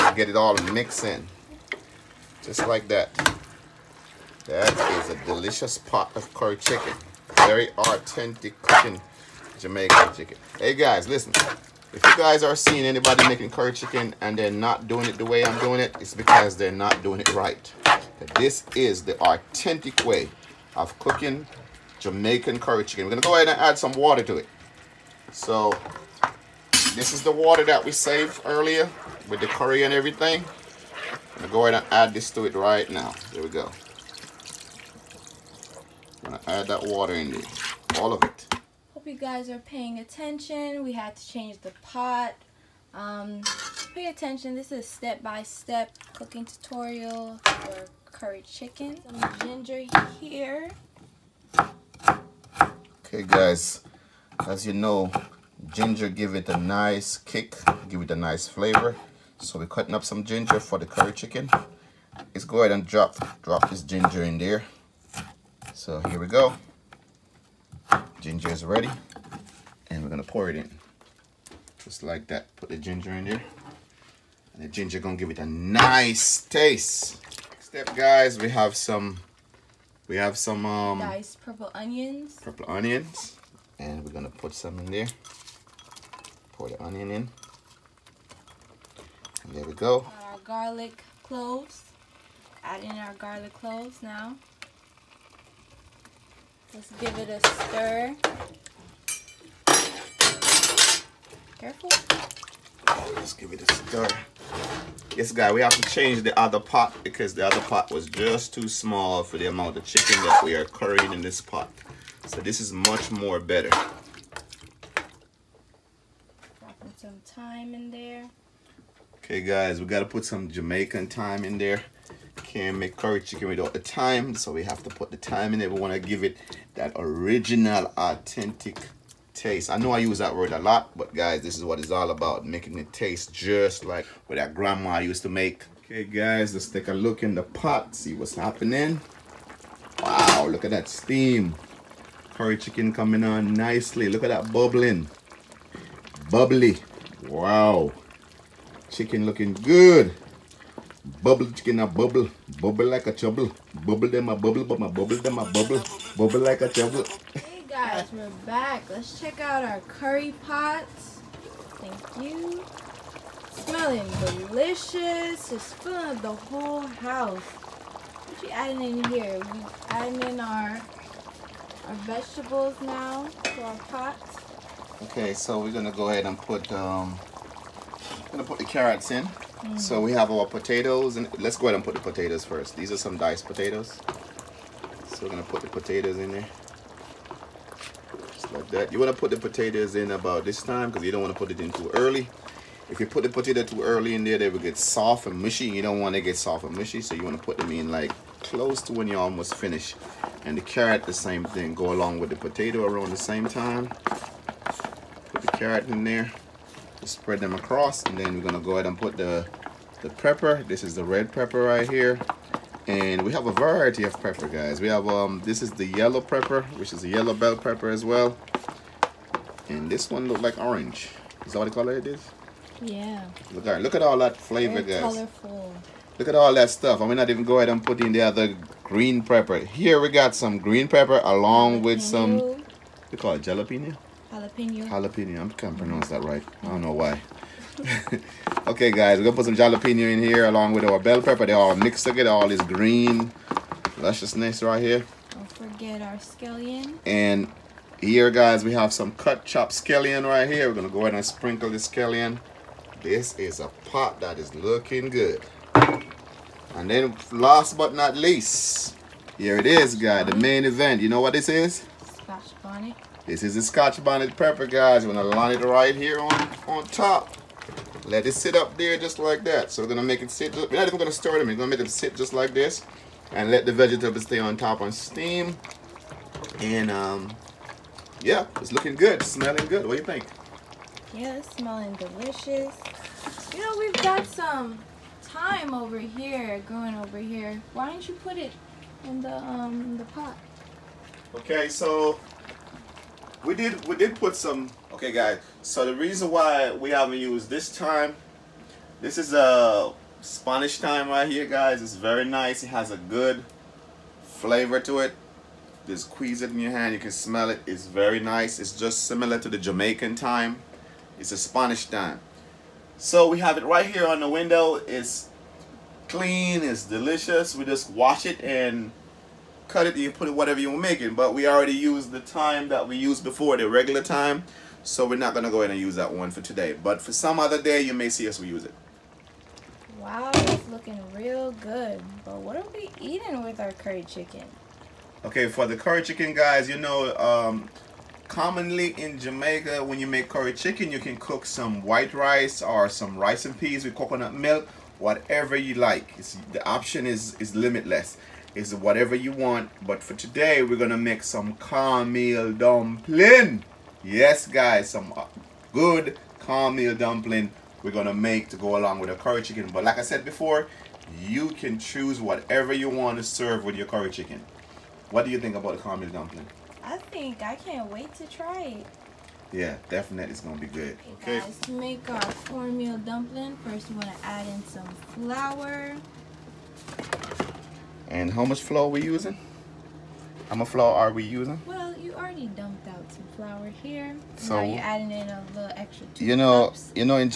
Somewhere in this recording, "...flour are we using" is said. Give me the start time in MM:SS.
06:20.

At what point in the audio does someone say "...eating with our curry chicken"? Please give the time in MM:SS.
05:33.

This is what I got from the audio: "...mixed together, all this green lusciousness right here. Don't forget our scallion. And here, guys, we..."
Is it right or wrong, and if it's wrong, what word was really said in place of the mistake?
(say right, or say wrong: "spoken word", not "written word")
right.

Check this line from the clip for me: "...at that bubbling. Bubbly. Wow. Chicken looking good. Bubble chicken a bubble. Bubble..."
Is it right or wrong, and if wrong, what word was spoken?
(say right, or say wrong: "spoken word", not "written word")
right.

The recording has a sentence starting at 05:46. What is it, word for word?
It's, the option is, is limitless.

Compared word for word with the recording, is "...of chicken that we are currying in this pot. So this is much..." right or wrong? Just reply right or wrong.
right.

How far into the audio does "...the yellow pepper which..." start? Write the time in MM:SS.
03:35.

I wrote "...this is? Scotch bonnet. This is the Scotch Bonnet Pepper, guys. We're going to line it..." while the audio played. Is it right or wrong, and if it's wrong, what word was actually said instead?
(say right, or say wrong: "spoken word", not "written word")
right.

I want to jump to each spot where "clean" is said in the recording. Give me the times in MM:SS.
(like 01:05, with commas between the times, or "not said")
05:16.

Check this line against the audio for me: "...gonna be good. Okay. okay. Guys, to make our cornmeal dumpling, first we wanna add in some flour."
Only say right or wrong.
right.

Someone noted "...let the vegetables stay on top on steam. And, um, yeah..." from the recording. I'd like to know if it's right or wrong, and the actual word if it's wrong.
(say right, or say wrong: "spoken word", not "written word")
right.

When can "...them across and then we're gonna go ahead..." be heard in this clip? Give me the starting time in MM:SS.
03:27.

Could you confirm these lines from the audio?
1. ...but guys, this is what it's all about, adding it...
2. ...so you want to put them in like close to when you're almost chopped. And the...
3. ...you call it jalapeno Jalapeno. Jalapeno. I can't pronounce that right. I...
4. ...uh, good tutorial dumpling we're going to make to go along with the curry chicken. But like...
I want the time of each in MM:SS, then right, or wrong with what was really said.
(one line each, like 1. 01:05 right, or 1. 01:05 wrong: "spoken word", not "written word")
1. 02:10 wrong: "making", not "adding"
2. 03:17 wrong: "finished", not "chopped"
3. 03:53 right
4. 05:55 wrong: "cornmeal", not "tutorial".